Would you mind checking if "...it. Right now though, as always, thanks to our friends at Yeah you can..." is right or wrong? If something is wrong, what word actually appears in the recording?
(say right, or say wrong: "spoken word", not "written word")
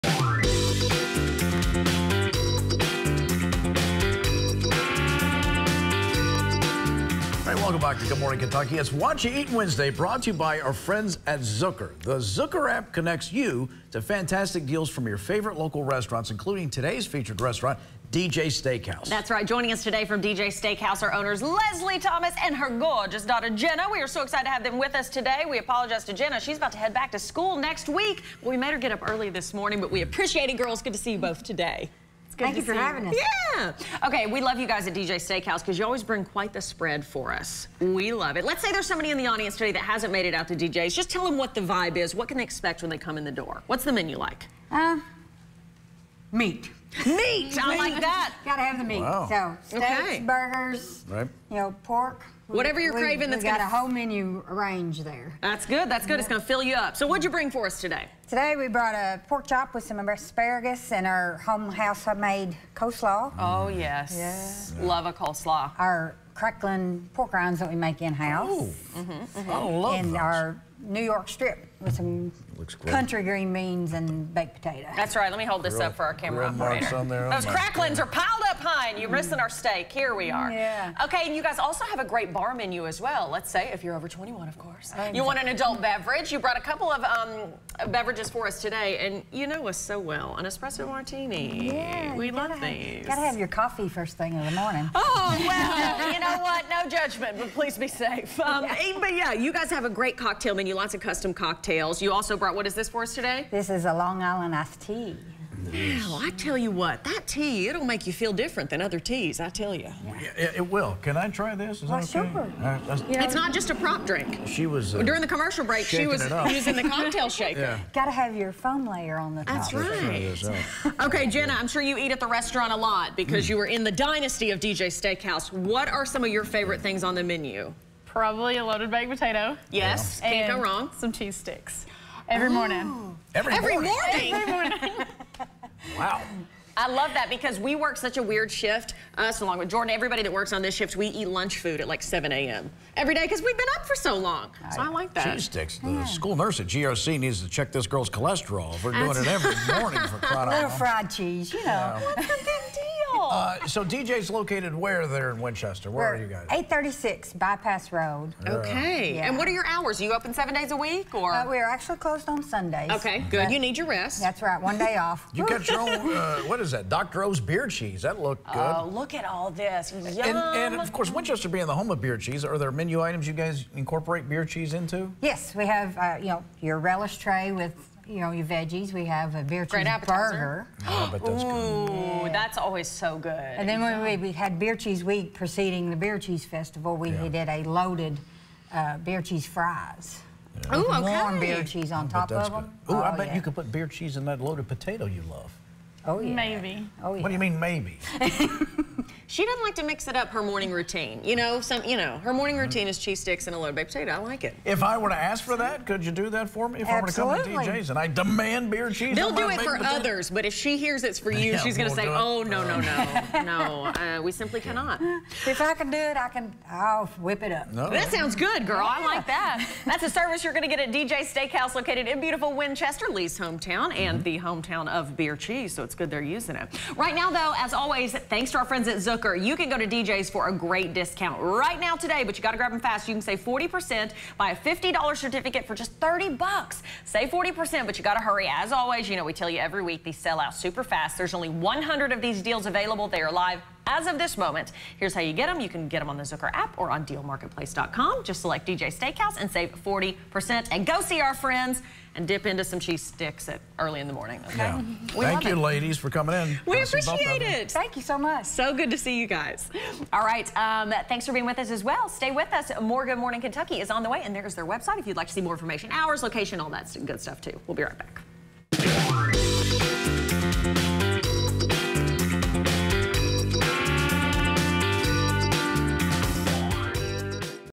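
wrong: "Zook", not "Yeah".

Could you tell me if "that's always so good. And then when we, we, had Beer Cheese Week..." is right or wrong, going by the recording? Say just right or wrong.
right.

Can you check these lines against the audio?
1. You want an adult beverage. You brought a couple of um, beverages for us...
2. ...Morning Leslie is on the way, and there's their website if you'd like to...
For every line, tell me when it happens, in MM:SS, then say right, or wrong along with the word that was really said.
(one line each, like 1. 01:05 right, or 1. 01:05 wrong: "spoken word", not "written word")
1. 01:25 right
2. 04:23 wrong: "Kentucky", not "Leslie".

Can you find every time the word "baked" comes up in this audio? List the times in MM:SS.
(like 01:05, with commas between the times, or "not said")
01:14, 02:08, 03:23.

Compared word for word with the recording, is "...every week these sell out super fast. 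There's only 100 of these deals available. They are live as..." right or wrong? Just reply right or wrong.
right.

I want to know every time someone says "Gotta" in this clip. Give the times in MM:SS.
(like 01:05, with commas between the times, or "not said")
00:48, 01:33.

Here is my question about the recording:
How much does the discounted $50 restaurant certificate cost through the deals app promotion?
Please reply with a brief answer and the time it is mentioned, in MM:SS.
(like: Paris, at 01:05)
$30, at 03:55.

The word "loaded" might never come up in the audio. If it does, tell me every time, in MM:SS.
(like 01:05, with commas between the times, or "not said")
02:08, 03:07, 03:14, 03:23.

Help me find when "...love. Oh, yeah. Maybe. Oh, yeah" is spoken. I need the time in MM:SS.
03:15.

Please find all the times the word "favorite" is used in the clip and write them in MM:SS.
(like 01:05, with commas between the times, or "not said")
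00:15, 02:06.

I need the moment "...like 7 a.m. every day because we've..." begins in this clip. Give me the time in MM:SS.
02:21.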